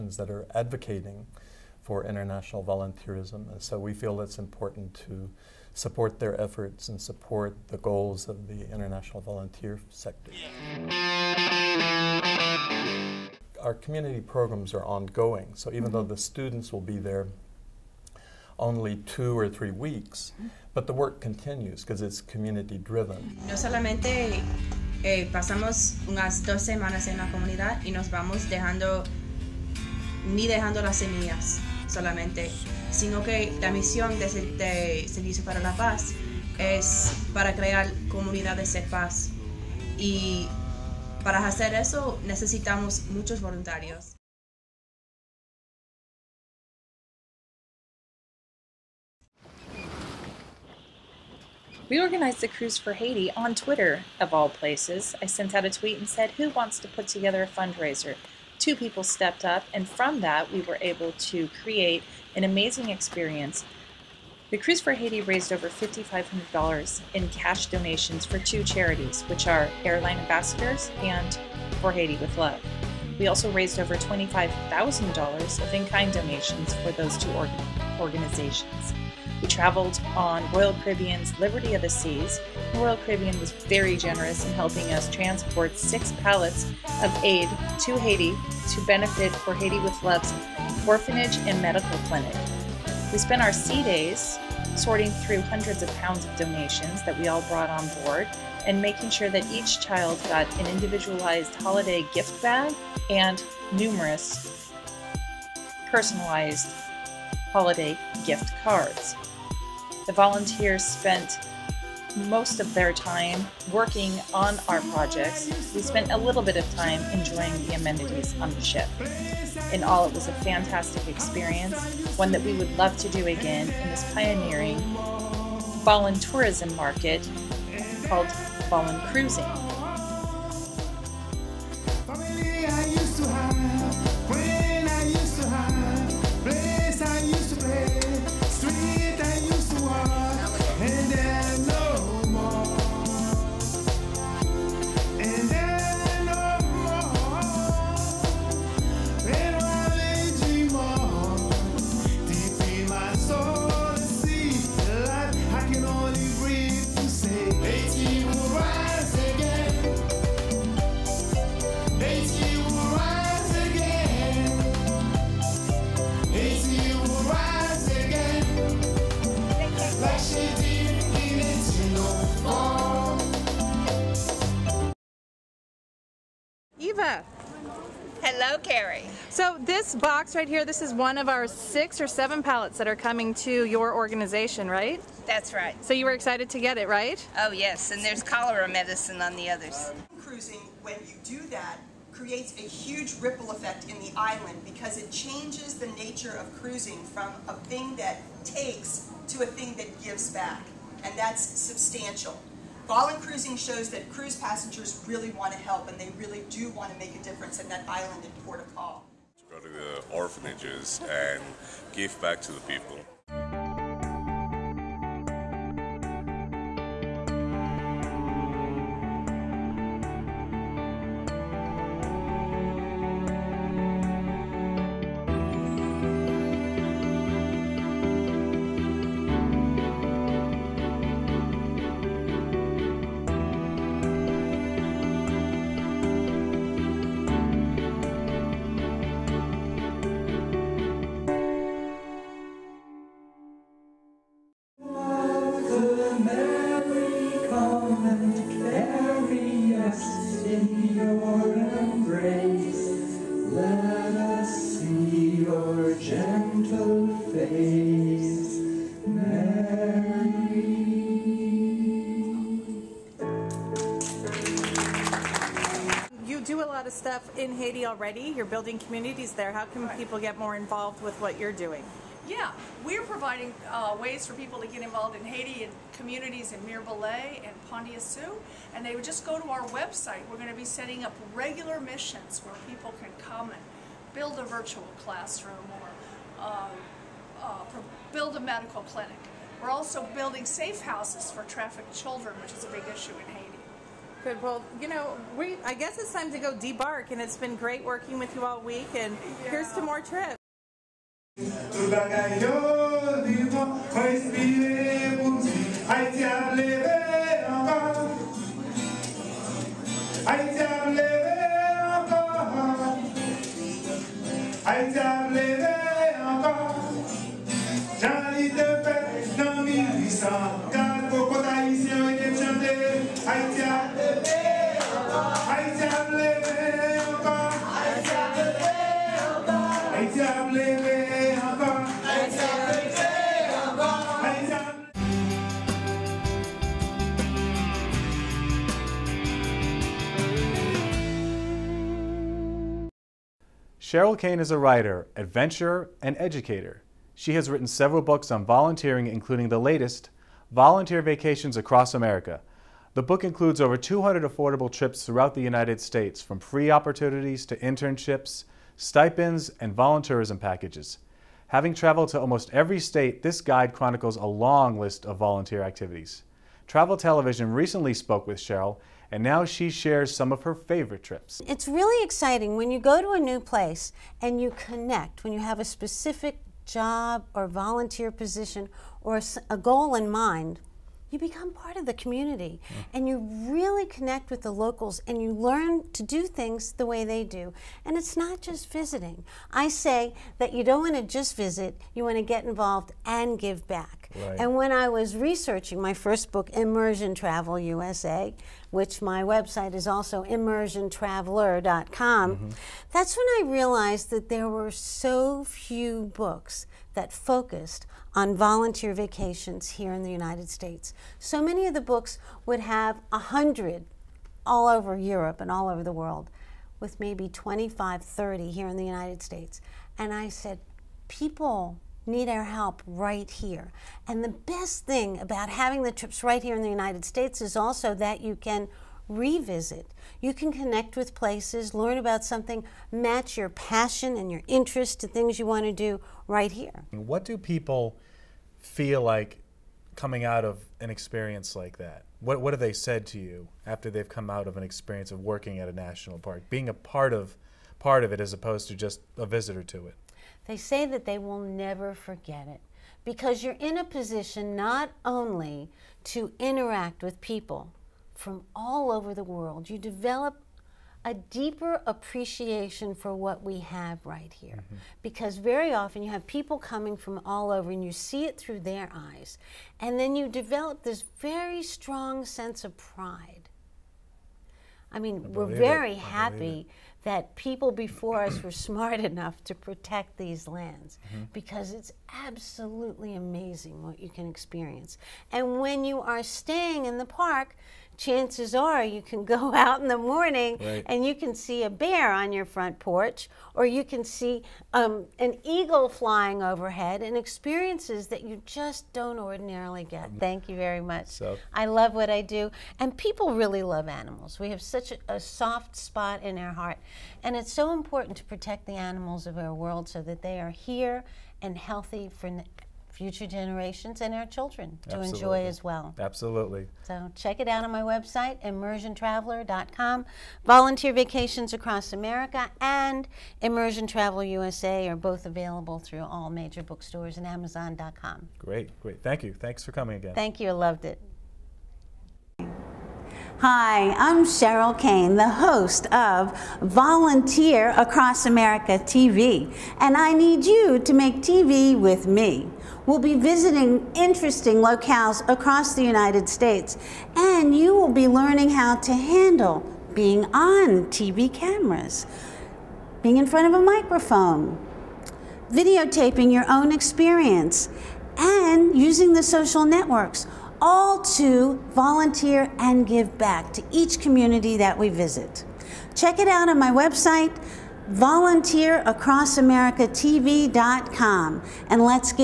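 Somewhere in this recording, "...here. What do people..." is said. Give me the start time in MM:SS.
07:16.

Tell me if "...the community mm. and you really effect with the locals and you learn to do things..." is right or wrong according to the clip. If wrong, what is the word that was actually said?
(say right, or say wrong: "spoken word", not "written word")
wrong: "connect", not "effect".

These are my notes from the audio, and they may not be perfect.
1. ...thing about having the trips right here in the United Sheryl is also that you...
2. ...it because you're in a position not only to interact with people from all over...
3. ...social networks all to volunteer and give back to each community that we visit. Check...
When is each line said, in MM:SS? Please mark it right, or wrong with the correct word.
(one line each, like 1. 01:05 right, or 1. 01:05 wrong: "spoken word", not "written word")
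1. 07:04 wrong: "States", not "Sheryl"
2. 07:32 right
3. 09:19 right.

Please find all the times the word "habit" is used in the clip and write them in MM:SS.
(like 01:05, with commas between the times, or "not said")
not said.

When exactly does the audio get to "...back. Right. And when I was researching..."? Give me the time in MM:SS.
06:33.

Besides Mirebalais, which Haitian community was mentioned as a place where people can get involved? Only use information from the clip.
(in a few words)
Pandiassou.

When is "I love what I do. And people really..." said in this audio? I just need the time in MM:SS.
08:21.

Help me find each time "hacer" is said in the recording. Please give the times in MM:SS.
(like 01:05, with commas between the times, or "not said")
00:41.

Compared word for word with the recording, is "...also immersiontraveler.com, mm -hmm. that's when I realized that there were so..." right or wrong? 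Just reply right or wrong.
right.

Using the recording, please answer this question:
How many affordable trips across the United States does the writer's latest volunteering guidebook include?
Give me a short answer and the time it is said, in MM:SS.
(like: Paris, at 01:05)
over 200, at 05:53.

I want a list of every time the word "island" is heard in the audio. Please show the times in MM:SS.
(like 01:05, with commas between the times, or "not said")
03:14, 03:27.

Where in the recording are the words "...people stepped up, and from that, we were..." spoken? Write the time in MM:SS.
00:58.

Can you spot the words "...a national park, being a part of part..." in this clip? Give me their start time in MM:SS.
07:25.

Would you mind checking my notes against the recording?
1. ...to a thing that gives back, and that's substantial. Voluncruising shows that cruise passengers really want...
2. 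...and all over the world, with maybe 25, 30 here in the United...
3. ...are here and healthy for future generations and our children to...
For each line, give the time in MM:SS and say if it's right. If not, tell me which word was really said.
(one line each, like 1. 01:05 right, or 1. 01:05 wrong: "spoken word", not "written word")
1. 03:19 right
2. 06:55 right
3. 08:30 right.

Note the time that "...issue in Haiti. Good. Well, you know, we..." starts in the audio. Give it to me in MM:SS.
04:52.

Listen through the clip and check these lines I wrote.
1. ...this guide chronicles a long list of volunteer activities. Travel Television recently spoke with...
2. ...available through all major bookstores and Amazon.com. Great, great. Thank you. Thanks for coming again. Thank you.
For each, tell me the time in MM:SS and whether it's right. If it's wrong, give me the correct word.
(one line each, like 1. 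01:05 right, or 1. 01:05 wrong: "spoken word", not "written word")
1. 06:03 right
2. 08:45 right.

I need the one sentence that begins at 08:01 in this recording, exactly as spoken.
because it's absolutely amazing what you can experience.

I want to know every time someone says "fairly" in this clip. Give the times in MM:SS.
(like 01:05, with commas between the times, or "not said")
not said.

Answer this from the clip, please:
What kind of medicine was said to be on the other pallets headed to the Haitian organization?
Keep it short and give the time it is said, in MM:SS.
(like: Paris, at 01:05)
cholera medicine, at 03:08.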